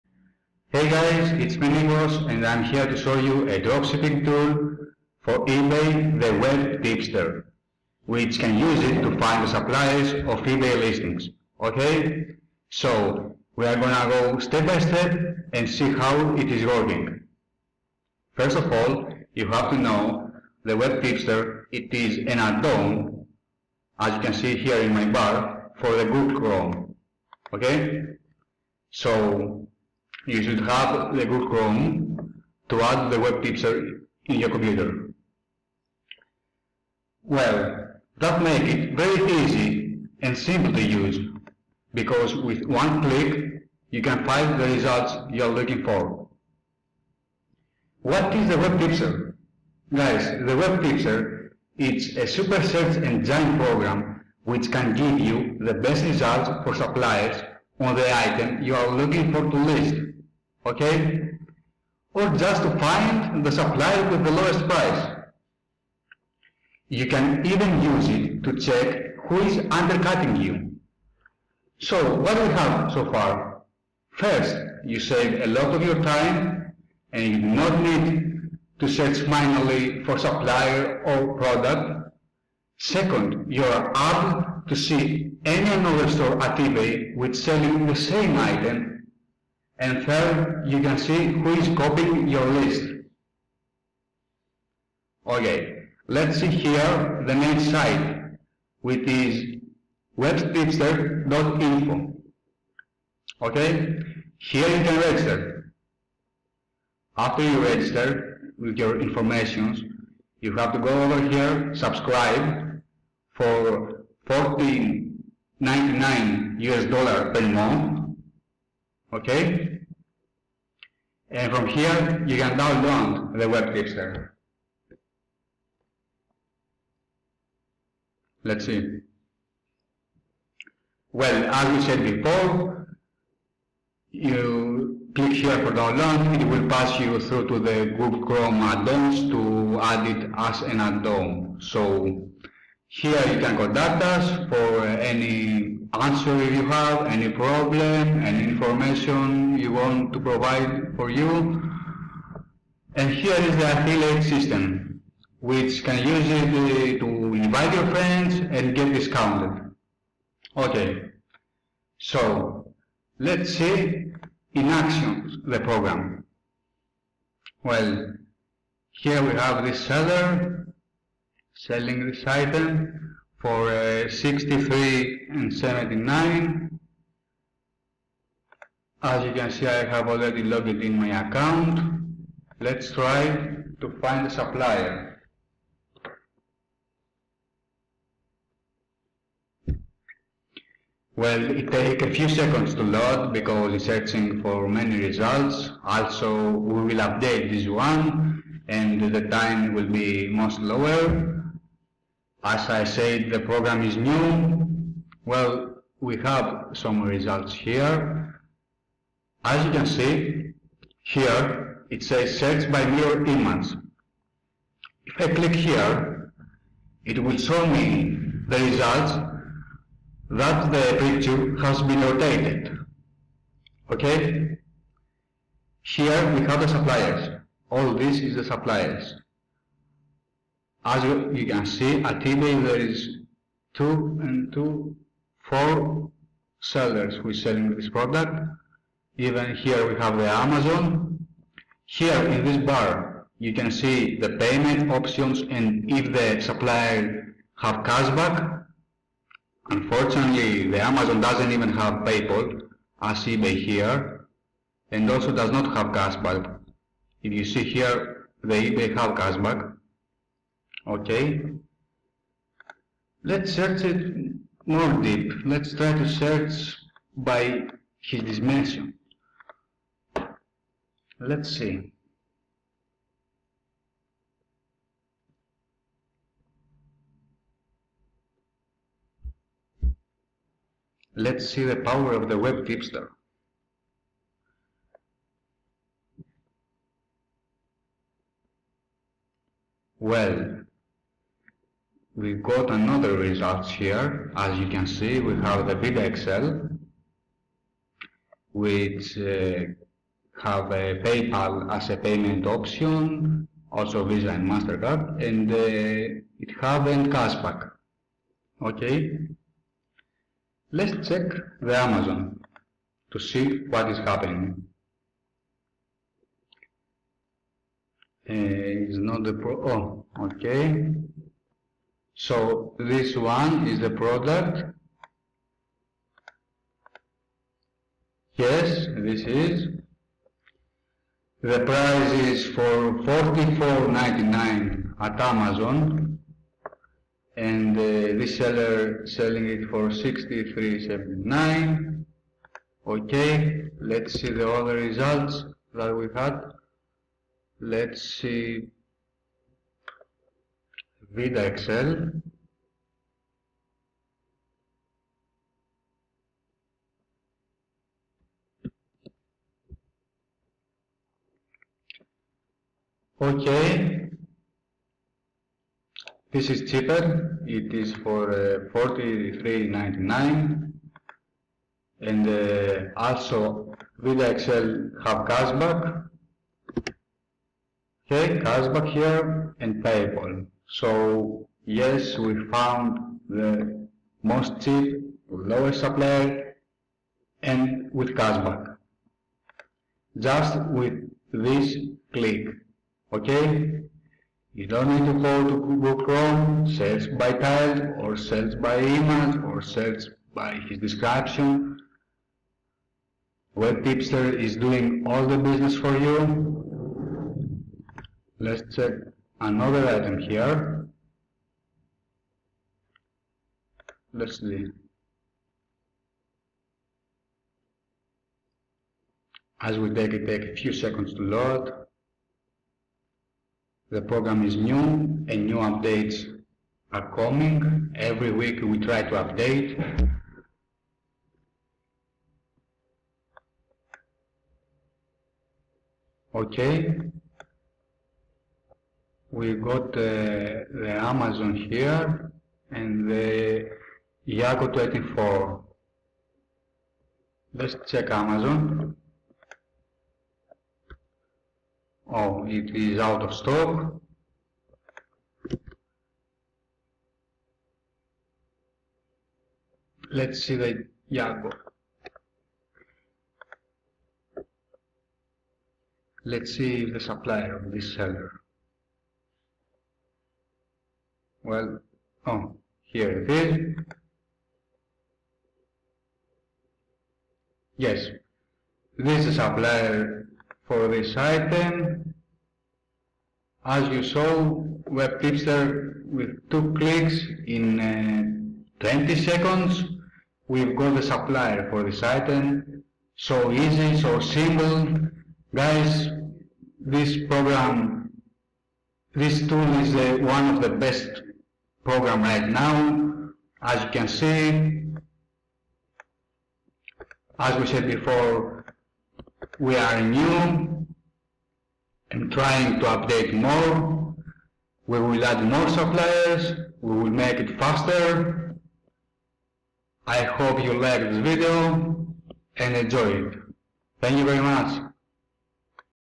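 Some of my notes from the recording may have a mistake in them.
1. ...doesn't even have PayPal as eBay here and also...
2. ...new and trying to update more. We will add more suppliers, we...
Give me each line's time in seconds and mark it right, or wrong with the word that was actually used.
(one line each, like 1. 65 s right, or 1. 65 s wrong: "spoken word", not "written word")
1. 251 s right
2. 510 s right.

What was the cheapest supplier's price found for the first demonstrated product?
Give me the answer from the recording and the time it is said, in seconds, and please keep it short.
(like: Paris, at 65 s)
$43.99, at 368 s.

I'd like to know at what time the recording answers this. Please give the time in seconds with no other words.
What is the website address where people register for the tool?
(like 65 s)
100 s.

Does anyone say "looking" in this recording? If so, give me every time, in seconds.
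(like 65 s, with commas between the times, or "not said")
45 s, 58 s.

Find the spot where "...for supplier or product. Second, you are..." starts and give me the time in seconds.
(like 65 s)
80 s.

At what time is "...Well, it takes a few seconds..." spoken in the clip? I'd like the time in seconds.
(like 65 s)
191 s.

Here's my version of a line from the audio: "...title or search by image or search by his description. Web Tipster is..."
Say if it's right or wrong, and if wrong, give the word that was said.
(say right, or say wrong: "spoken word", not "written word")
right.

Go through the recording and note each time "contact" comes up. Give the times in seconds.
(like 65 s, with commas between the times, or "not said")
143 s.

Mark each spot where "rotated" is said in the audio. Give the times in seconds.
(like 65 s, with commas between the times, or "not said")
222 s.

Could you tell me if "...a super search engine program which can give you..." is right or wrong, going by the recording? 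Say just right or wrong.
right.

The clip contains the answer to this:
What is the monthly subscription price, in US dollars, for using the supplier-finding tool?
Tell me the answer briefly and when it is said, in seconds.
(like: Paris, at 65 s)
$14.99, at 114 s.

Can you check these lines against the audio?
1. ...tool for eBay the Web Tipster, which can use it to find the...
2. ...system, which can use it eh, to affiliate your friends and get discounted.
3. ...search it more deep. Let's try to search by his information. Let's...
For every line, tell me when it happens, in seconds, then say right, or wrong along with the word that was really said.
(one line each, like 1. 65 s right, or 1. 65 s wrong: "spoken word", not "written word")
1. 4 s right
2. 154 s wrong: "invite", not "affiliate"
3. 263 s wrong: "dimension", not "information".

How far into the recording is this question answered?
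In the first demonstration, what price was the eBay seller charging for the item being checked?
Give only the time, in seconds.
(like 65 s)
339 s.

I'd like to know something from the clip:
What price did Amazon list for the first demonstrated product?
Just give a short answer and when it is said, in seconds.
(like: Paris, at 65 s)
$44.99, at 333 s.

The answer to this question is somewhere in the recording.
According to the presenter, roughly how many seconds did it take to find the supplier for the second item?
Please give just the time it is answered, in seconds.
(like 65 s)
488 s.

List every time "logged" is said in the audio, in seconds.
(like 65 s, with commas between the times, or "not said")
180 s.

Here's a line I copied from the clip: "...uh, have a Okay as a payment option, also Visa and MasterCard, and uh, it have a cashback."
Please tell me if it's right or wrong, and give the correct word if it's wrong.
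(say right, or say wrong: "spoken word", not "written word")
wrong: "PayPal", not "Okay".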